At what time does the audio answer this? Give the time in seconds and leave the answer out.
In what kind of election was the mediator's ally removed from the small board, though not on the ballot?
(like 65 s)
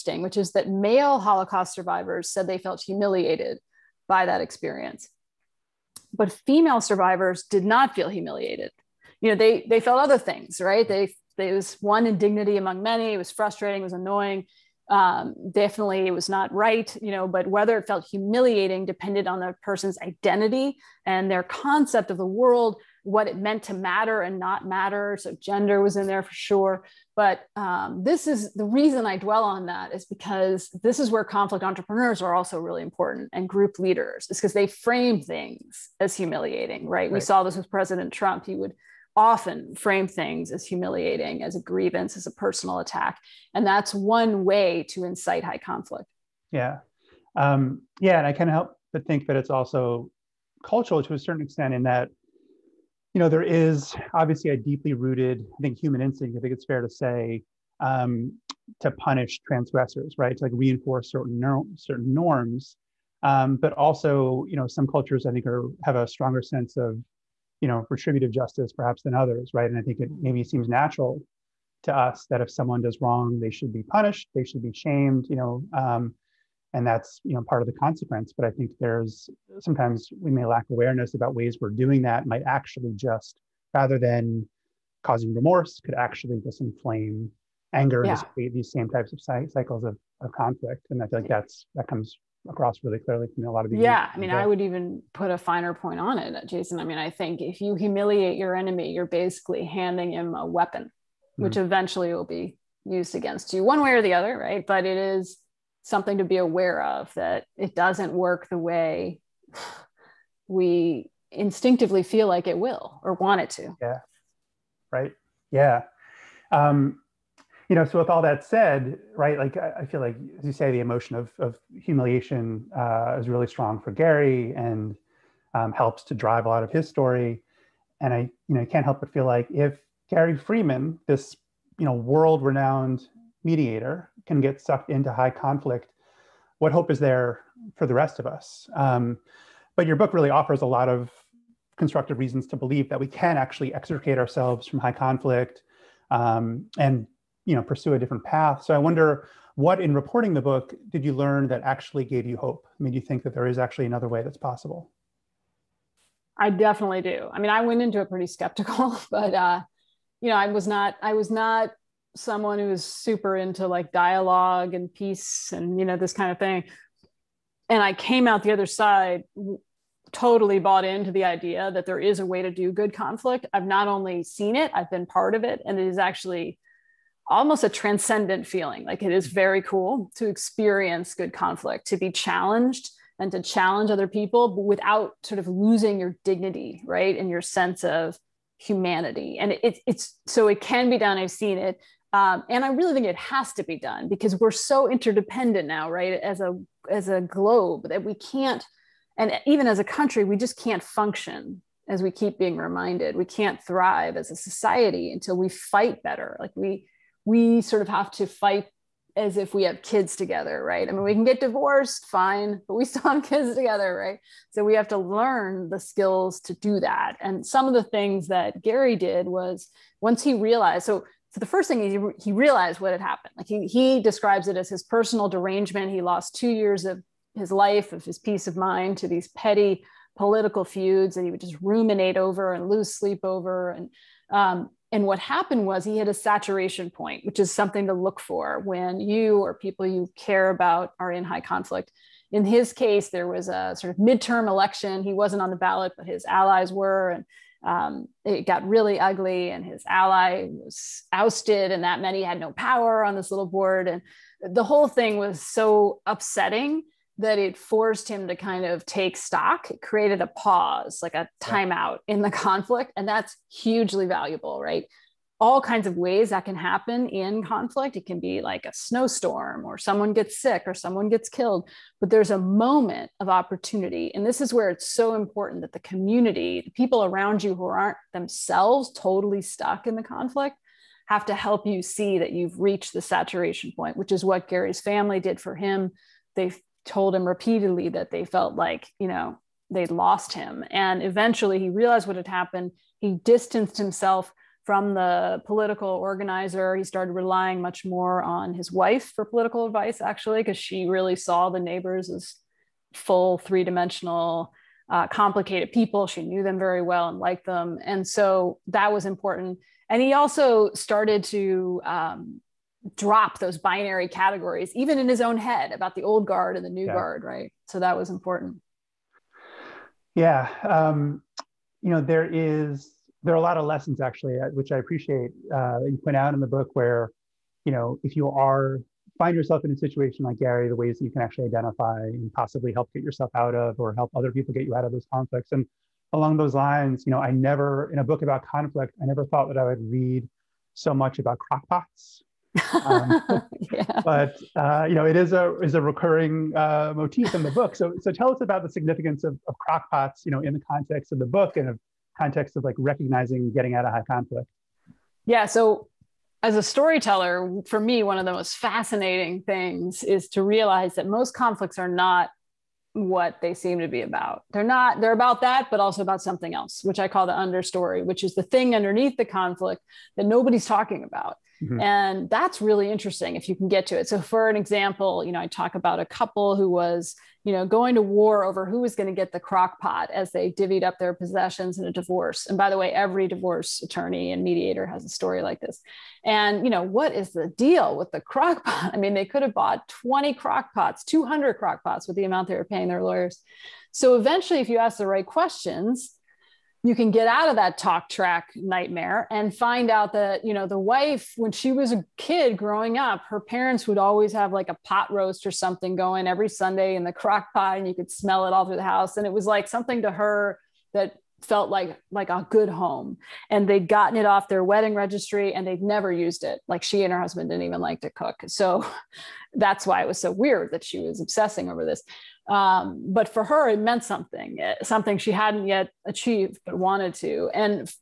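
243 s.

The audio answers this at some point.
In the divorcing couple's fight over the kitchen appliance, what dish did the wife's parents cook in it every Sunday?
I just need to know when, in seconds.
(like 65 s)
404 s.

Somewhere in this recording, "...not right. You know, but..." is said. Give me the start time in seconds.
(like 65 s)
16 s.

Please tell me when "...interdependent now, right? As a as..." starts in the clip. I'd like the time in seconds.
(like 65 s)
194 s.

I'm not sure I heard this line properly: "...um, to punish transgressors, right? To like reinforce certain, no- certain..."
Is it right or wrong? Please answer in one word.
right.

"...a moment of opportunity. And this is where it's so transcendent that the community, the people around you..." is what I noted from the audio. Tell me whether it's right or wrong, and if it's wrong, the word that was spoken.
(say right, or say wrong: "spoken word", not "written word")
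wrong: "important", not "transcendent".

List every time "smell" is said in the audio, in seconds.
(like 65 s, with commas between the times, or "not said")
408 s.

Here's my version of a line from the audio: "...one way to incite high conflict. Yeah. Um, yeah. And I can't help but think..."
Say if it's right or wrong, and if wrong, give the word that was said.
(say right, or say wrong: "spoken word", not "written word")
right.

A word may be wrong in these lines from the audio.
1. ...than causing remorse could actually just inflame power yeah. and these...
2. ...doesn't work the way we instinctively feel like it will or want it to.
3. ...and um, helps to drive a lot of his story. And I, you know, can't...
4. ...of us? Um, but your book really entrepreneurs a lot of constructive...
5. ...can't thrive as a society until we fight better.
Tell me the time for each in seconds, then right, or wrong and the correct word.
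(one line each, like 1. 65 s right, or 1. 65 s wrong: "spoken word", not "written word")
1. 83 s wrong: "anger", not "power"
2. 107 s right
3. 124 s right
4. 138 s wrong: "offers", not "entrepreneurs"
5. 203 s right.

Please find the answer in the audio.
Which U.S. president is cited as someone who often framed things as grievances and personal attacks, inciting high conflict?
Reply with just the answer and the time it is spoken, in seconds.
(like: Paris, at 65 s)
President Trump, at 37 s.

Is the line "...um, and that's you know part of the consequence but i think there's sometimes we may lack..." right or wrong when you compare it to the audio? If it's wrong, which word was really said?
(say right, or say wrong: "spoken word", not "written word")
right.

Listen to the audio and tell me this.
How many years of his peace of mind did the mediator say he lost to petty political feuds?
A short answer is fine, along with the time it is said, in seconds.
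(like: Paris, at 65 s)
2, at 226 s.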